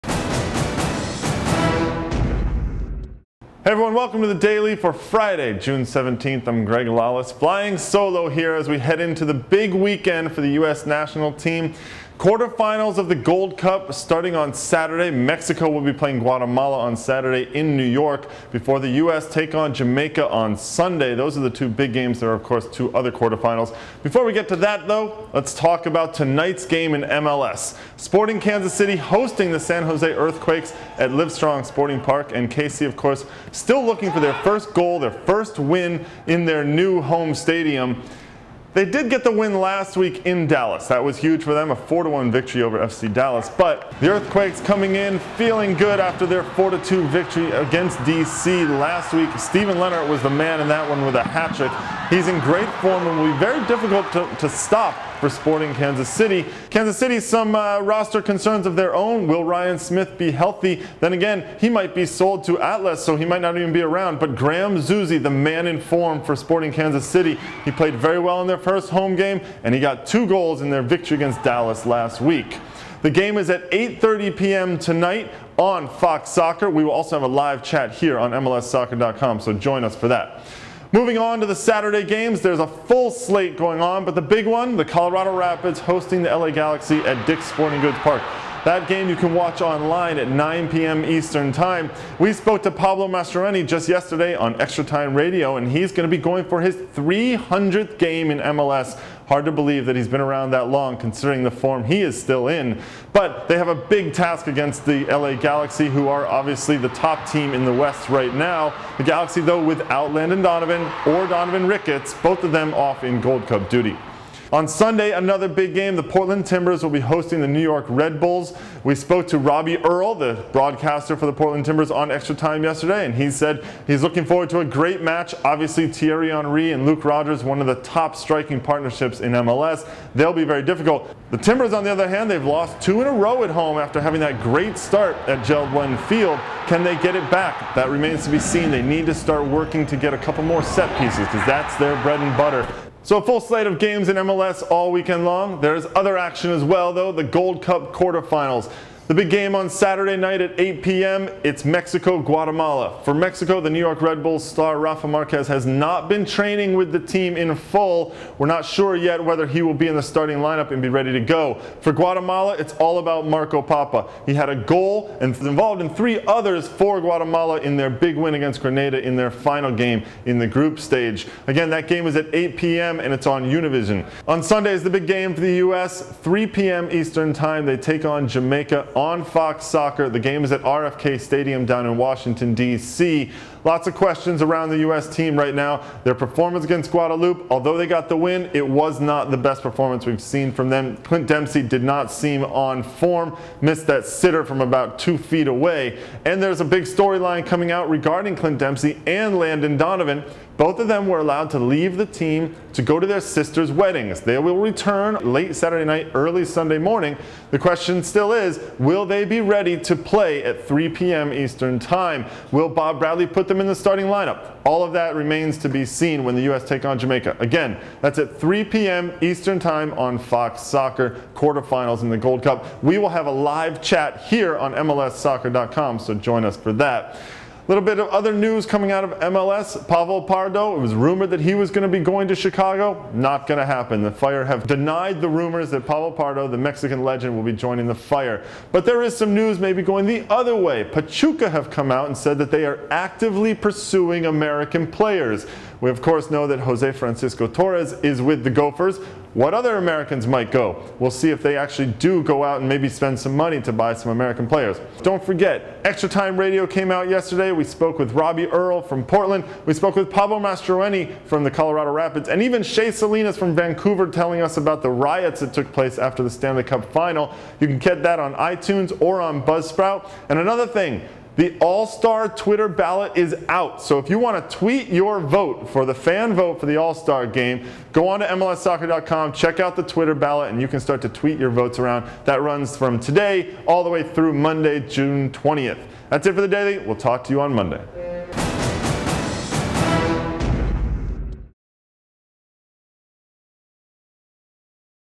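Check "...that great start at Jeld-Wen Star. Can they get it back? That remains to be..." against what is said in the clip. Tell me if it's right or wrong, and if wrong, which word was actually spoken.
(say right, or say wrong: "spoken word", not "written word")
wrong: "Field", not "Star".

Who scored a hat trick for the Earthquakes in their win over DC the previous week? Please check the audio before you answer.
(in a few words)
Steven Lenhart.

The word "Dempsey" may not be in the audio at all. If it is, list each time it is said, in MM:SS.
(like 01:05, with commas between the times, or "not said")
03:11, 03:18.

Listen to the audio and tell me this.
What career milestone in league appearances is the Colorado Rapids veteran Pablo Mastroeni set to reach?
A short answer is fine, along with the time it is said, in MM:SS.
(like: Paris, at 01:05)
300th game, at 01:36.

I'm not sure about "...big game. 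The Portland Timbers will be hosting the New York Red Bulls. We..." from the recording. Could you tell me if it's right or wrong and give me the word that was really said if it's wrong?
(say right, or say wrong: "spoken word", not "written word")
right.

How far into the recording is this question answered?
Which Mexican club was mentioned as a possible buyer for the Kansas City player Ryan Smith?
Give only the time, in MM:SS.
01:02.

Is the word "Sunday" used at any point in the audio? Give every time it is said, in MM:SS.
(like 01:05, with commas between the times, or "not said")
00:20, 01:54, 02:54, 03:26.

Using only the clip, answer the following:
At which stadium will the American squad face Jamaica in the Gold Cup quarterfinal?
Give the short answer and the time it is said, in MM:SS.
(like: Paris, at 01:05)
RFK Stadium, at 03:00.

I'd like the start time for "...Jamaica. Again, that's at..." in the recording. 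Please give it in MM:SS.
03:36.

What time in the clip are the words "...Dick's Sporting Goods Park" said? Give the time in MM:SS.
01:27.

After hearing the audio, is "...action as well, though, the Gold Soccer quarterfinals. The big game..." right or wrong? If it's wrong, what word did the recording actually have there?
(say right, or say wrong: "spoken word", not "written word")
wrong: "Cup", not "Soccer".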